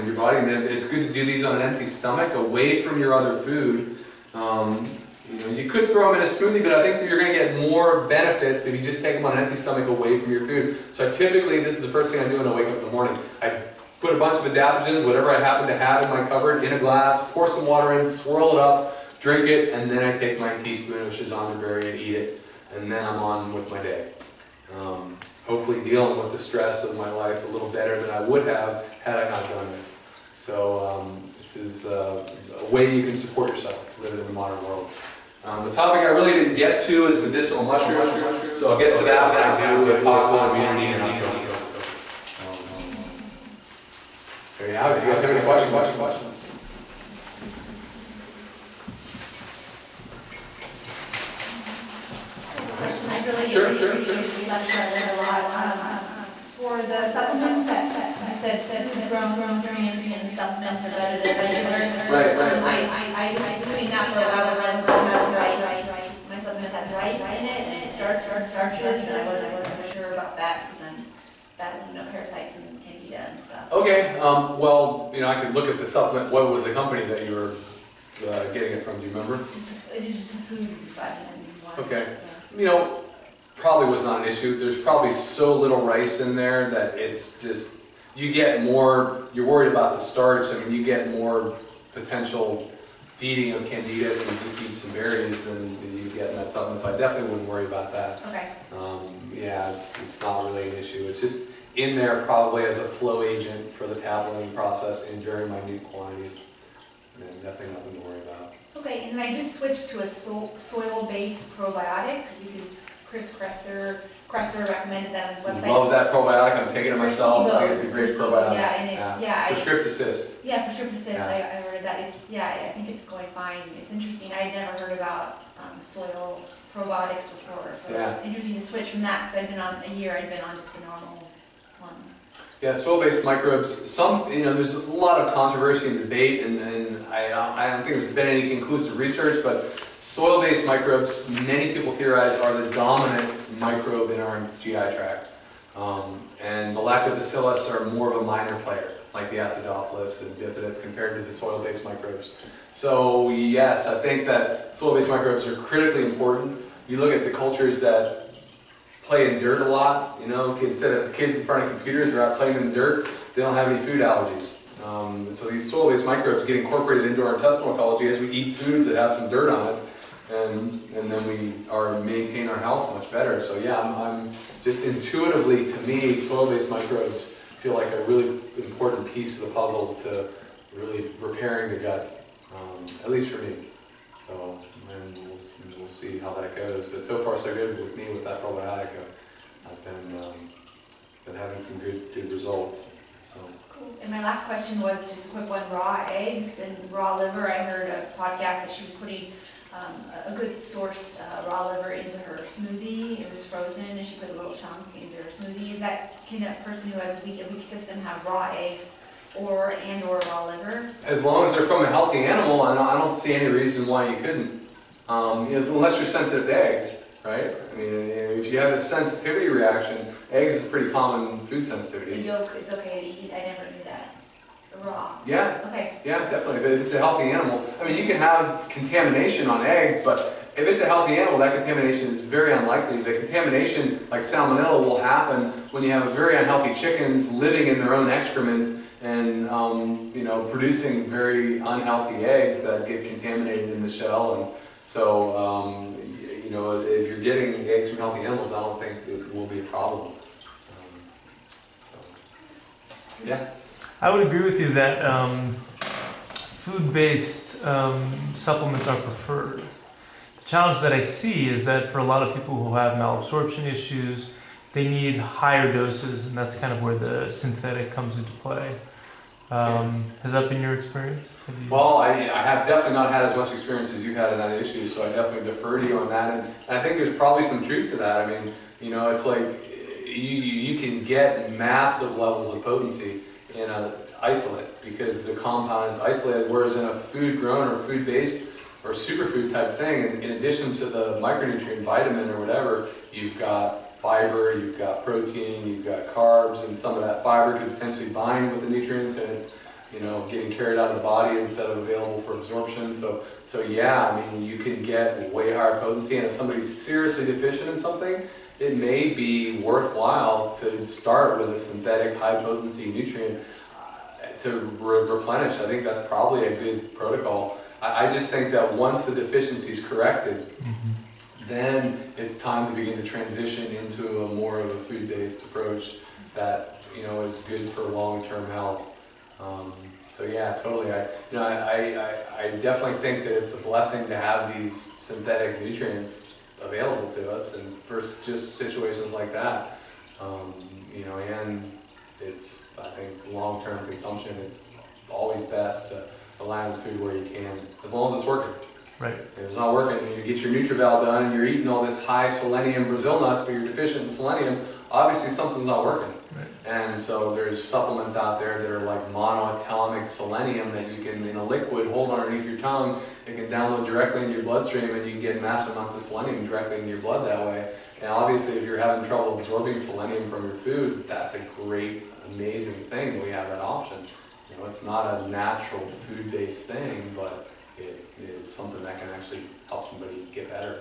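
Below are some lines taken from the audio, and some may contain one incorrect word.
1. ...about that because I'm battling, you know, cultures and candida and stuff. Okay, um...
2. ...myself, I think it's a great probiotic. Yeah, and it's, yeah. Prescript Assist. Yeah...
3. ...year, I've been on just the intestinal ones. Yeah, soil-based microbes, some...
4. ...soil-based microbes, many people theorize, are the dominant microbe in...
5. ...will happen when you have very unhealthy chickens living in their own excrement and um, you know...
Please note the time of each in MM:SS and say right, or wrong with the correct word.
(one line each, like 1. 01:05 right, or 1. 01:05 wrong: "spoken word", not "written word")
1. 01:10 wrong: "parasites", not "cultures"
2. 01:56 right
3. 02:09 wrong: "normal", not "intestinal"
4. 02:19 right
5. 03:54 right.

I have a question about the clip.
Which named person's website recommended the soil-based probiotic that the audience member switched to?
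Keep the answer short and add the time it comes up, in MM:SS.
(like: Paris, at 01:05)
Chris Kresser, at 01:53.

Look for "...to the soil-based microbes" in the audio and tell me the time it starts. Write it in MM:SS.
02:31.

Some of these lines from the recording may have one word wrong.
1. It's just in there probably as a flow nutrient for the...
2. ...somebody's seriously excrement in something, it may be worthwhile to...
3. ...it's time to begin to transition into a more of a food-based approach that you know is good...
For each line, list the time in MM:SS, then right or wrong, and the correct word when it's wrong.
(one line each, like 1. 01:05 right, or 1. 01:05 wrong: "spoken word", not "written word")
1. 01:41 wrong: "agent", not "nutrient"
2. 05:06 wrong: "deficient", not "excrement"
3. 05:22 right.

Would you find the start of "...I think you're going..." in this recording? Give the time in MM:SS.
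00:06.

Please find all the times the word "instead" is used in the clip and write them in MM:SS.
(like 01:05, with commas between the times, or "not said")
02:40, 05:01.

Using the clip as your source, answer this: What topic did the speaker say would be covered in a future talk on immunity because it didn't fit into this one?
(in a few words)
medicinal mushrooms.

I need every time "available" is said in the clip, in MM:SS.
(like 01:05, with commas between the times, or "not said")
05:01, 05:36.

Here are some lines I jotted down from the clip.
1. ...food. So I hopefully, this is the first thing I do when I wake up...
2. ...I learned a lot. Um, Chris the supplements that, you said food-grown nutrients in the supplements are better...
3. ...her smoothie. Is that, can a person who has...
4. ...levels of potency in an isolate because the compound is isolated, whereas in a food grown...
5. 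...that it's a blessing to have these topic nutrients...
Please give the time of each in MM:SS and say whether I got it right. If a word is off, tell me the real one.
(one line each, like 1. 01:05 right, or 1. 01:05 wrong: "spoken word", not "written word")
1. 00:10 wrong: "typically", not "hopefully"
2. 00:54 wrong: "For", not "Chris"
3. 03:25 right
4. 04:42 right
5. 05:33 wrong: "synthetic", not "topic".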